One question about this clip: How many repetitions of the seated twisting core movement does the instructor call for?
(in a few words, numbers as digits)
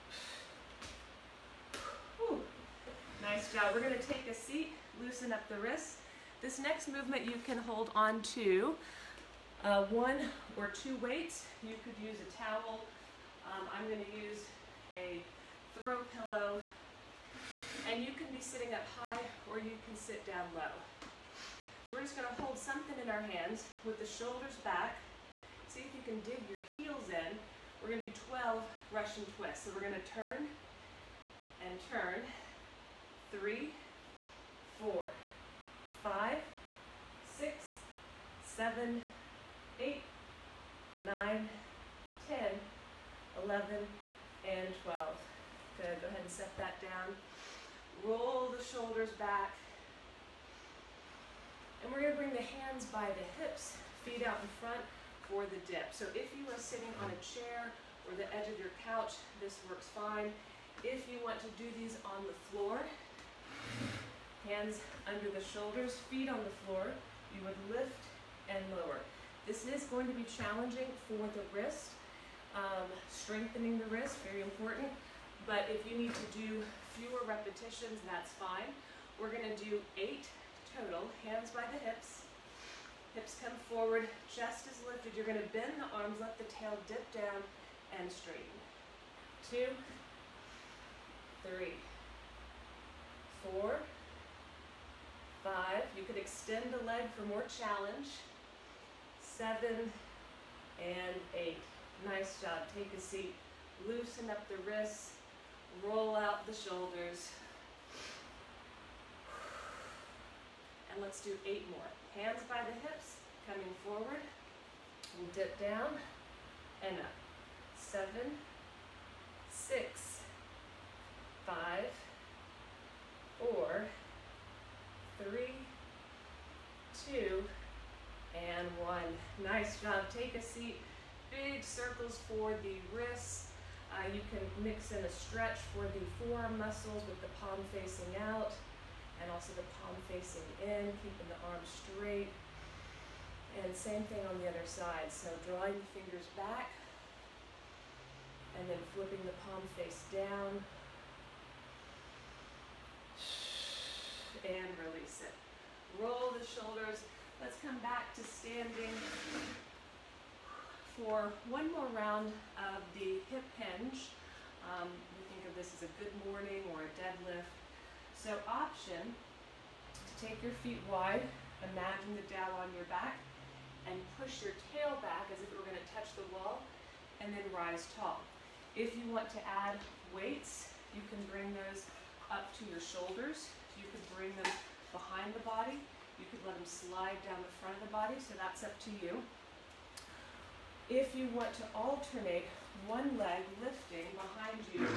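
12.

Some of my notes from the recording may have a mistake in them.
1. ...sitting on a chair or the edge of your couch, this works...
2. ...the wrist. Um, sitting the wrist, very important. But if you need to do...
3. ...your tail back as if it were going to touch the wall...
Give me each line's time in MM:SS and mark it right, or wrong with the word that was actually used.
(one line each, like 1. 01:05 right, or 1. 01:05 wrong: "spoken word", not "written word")
1. 00:56 right
2. 01:11 wrong: "strengthening", not "sitting"
3. 02:54 right.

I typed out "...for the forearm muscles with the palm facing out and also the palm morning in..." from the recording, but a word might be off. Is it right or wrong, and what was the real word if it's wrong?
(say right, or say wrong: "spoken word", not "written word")
wrong: "facing", not "morning".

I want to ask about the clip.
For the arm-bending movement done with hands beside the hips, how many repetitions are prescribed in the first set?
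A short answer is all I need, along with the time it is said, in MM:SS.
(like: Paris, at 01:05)
8, at 01:19.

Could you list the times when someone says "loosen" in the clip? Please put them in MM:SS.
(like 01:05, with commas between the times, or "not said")
00:04, 01:43.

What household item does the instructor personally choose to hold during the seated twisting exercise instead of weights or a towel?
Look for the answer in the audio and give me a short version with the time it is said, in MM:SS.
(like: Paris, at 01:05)
throw pillow, at 00:15.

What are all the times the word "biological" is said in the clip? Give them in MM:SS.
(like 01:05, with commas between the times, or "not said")
not said.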